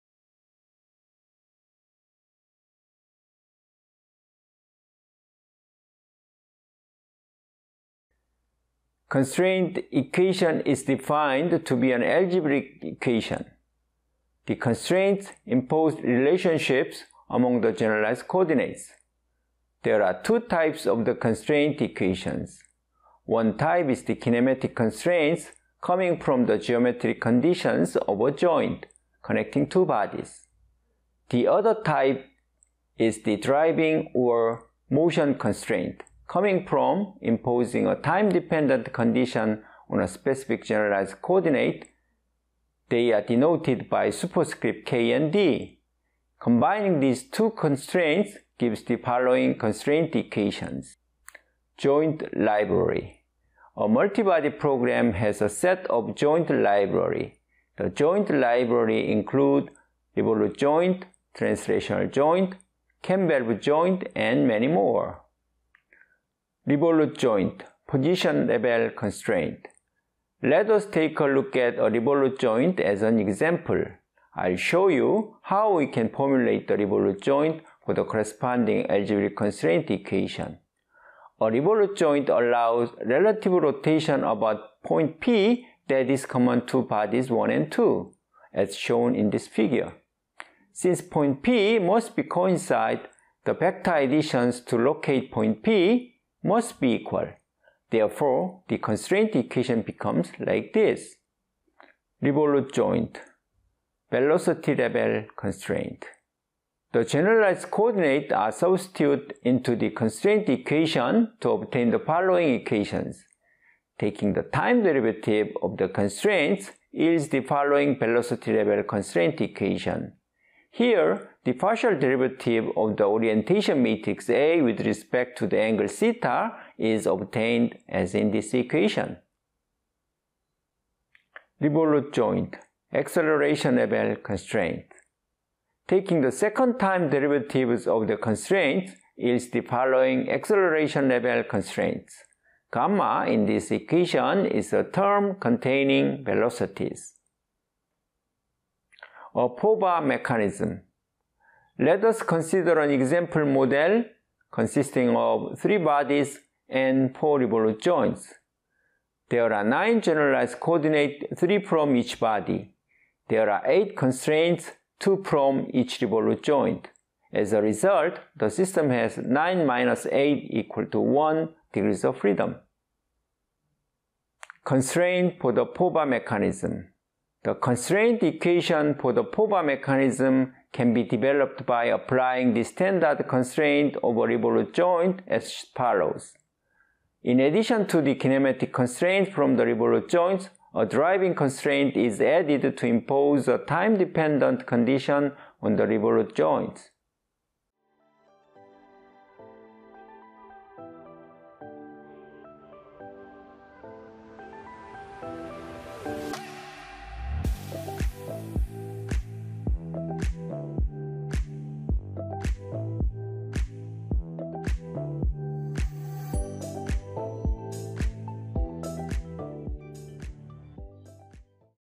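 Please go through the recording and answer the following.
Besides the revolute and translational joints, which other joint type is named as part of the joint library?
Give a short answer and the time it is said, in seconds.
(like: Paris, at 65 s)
Campbell joint, at 63 s.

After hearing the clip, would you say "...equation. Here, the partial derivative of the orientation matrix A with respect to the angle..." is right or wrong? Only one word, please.
right.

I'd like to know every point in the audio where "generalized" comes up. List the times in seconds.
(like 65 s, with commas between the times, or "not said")
17 s, 40 s, 107 s, 160 s.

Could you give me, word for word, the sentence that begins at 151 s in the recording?
Let us consider an example model consisting of three bodies and four revolute joints.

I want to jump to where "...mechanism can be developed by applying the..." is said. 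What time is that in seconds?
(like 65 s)
179 s.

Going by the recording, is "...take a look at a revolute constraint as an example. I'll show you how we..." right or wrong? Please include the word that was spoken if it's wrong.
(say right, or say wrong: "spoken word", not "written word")
wrong: "joint", not "constraint".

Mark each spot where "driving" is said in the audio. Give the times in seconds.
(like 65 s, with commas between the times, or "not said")
33 s, 190 s.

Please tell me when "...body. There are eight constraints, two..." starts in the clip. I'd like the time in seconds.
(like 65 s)
162 s.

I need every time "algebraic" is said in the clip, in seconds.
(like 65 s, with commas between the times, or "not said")
12 s, 78 s.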